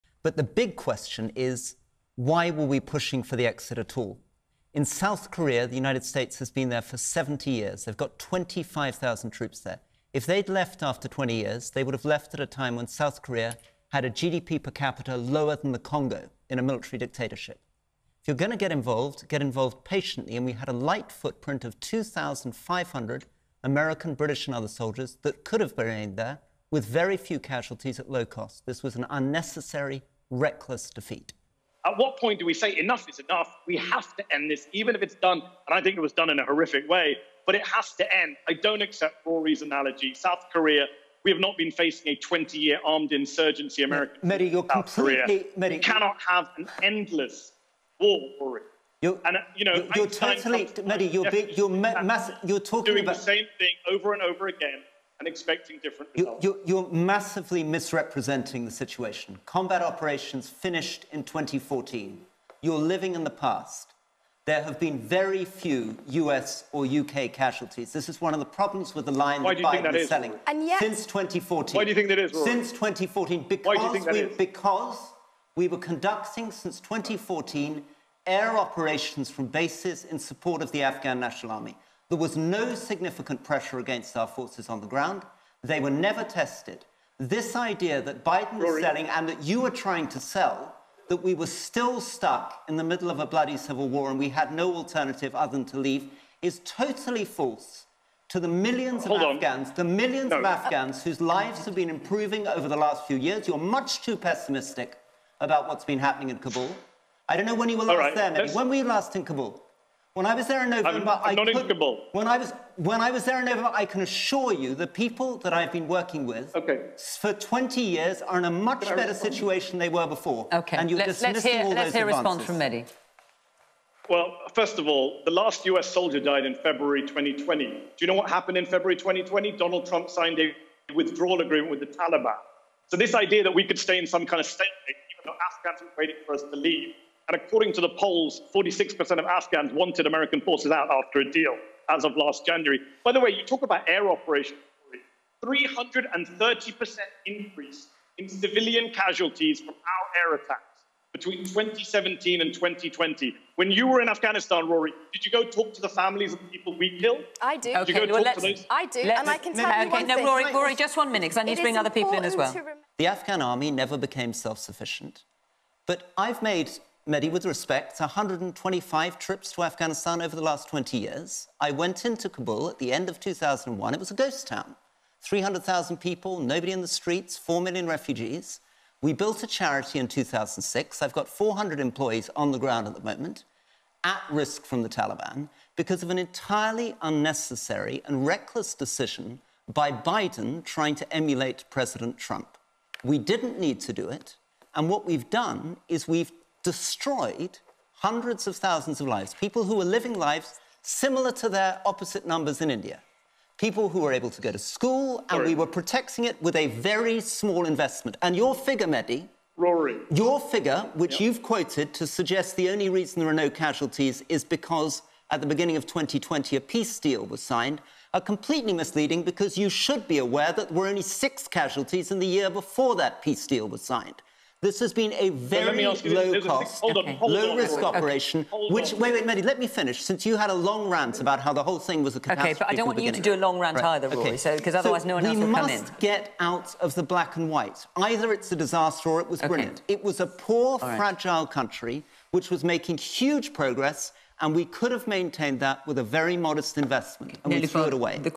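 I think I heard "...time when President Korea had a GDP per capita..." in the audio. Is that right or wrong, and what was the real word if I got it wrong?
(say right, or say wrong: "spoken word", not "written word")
wrong: "South", not "President".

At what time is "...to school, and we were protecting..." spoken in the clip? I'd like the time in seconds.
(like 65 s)
204 s.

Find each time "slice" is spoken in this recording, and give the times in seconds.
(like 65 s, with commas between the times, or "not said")
not said.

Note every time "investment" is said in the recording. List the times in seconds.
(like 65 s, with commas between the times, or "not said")
207 s, 246 s.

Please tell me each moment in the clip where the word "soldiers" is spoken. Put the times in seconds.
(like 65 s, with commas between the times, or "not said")
24 s, 125 s.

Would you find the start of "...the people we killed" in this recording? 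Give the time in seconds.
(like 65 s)
156 s.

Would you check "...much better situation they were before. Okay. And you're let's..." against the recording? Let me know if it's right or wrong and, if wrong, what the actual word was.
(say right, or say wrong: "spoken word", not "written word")
right.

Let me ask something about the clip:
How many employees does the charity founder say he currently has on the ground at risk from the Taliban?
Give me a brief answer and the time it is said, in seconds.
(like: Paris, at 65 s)
400, at 181 s.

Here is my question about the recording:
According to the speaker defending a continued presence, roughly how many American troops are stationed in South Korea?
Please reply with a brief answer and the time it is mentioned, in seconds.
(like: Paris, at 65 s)
25,000, at 8 s.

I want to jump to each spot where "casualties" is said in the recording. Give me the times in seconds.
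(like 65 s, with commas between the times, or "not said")
27 s, 67 s, 148 s, 213 s, 221 s.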